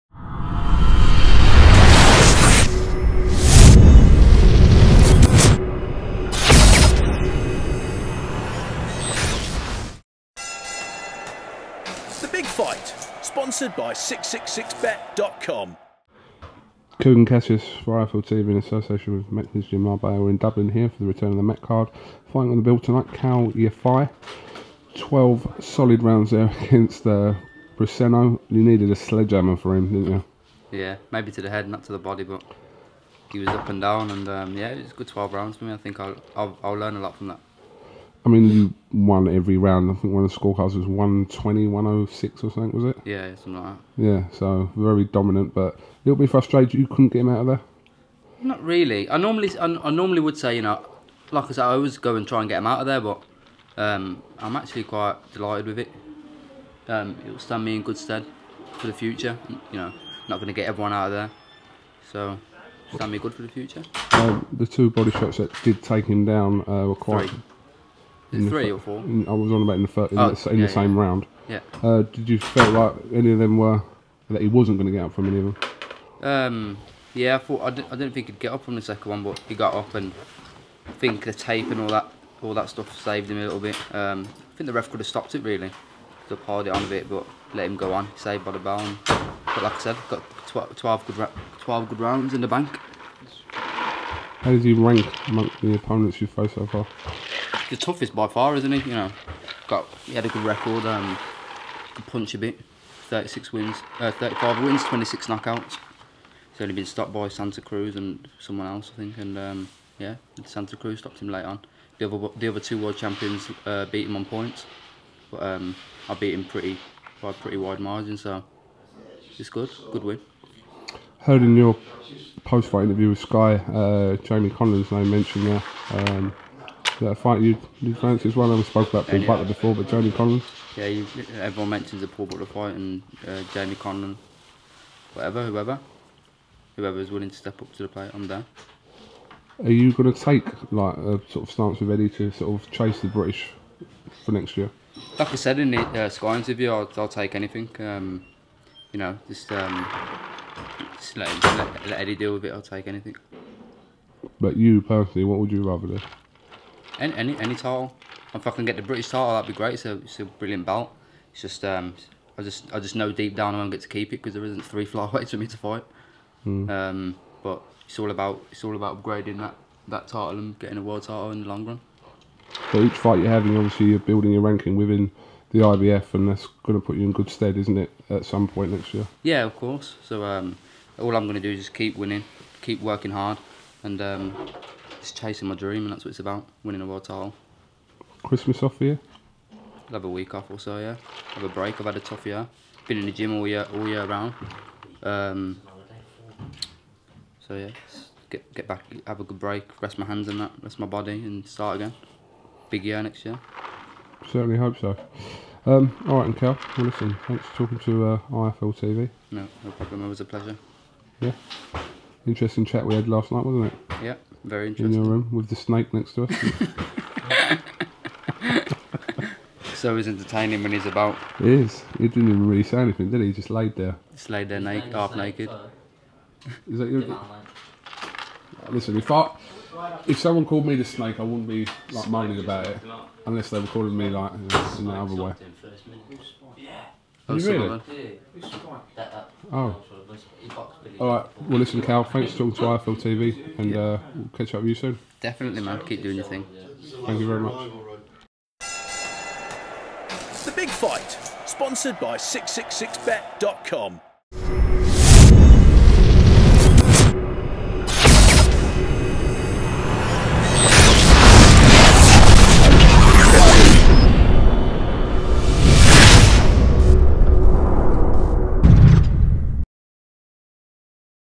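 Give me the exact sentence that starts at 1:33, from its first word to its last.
How does he rank amongst the opponents you've faced so far?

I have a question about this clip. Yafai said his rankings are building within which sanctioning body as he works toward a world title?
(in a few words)
IBF.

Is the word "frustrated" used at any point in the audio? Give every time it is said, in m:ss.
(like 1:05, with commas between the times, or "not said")
0:46.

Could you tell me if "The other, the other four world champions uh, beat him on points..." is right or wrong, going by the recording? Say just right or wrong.
wrong.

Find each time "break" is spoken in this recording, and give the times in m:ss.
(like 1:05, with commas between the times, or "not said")
3:11, 3:19.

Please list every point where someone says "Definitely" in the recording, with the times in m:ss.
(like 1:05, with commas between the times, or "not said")
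4:05.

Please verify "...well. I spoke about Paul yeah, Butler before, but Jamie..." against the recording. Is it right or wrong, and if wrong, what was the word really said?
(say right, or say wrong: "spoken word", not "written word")
right.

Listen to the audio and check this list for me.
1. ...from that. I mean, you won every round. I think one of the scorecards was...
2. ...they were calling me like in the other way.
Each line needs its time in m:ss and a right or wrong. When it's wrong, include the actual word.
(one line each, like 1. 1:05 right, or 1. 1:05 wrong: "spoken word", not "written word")
1. 0:37 right
2. 3:53 right.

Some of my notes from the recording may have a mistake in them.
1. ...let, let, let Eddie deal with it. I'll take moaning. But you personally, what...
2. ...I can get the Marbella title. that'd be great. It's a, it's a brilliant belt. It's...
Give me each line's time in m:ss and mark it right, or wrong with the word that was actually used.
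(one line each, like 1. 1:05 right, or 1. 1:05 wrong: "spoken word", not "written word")
1. 2:31 wrong: "anything", not "moaning"
2. 2:38 wrong: "British", not "Marbella".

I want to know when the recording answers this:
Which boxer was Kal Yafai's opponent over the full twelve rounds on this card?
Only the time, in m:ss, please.
0:27.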